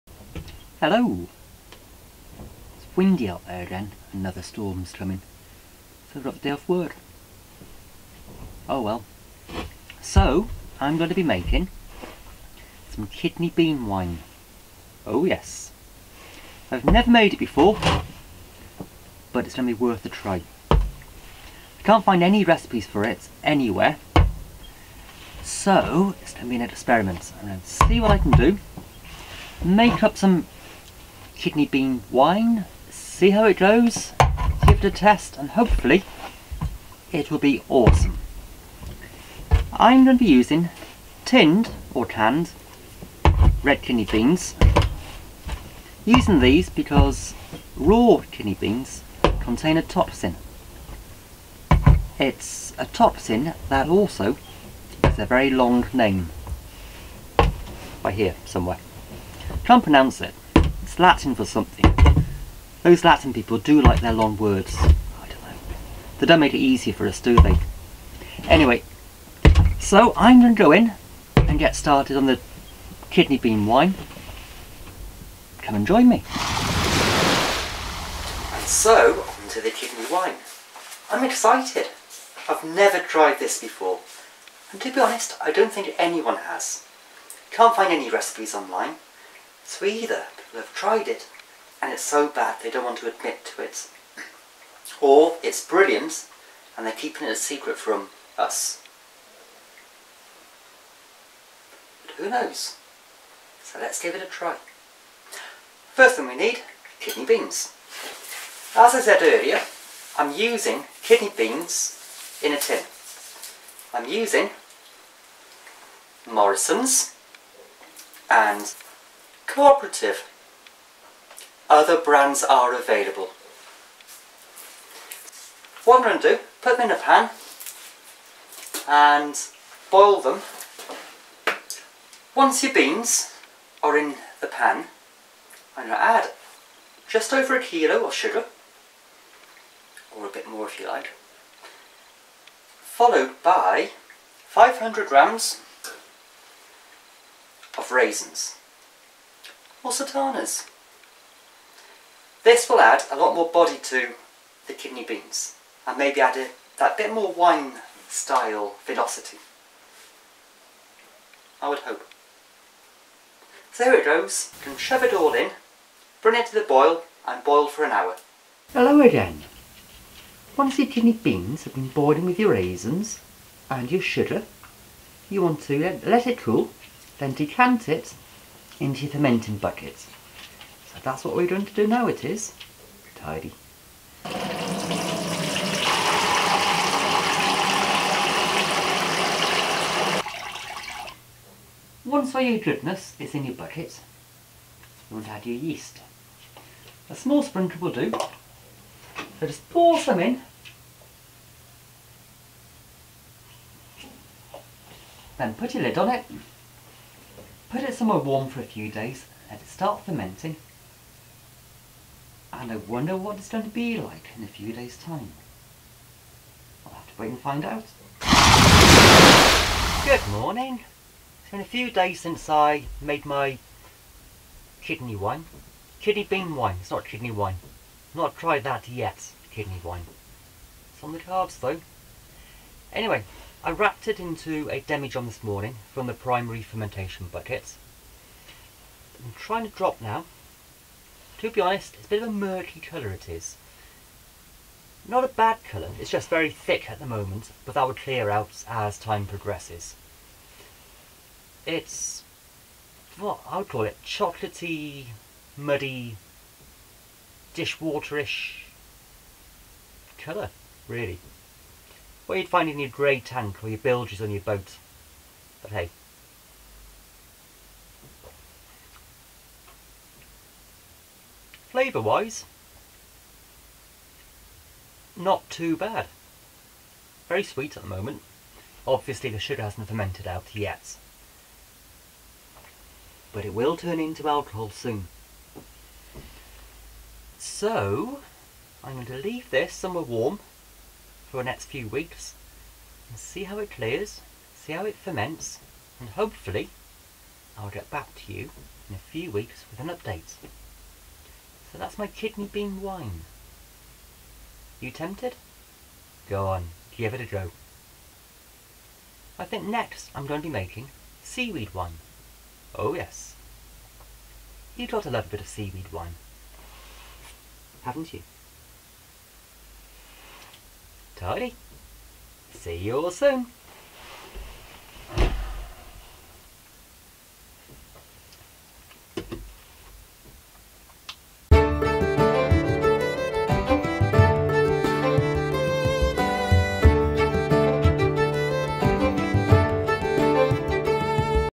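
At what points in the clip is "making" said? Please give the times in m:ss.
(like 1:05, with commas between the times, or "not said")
0:11, 5:10.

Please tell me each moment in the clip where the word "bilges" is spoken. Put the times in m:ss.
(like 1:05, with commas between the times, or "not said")
4:23.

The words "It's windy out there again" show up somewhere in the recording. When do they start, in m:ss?
0:02.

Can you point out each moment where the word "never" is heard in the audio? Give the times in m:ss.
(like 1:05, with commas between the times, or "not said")
0:16, 1:22.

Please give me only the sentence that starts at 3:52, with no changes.
Anyway, I wrapped it into a demijohn this morning from the primary fermentation bucket.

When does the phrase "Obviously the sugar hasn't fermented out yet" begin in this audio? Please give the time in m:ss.
4:38.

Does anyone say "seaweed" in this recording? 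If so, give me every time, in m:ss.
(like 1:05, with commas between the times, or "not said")
5:11, 5:15.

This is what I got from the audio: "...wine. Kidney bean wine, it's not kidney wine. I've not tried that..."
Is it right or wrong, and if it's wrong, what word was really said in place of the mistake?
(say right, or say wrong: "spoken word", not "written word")
right.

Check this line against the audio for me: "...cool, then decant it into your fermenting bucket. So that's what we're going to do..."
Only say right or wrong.
right.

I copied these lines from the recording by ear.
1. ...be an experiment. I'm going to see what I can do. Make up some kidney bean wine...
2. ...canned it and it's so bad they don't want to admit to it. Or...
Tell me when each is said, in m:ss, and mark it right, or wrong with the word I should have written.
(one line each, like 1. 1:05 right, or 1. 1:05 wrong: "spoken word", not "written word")
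1. 0:26 right
2. 1:30 wrong: "tried", not "canned".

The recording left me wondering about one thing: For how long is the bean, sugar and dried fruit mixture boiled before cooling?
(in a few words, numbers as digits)
an hour.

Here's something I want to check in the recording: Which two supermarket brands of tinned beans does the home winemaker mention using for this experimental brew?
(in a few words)
Morrison's and Cooperative.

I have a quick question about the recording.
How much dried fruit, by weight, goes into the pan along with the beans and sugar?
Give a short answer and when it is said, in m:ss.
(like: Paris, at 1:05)
500 grams, at 2:24.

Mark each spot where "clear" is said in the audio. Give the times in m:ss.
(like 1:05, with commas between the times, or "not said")
4:07, 4:53.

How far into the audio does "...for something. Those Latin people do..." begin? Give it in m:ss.
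1:01.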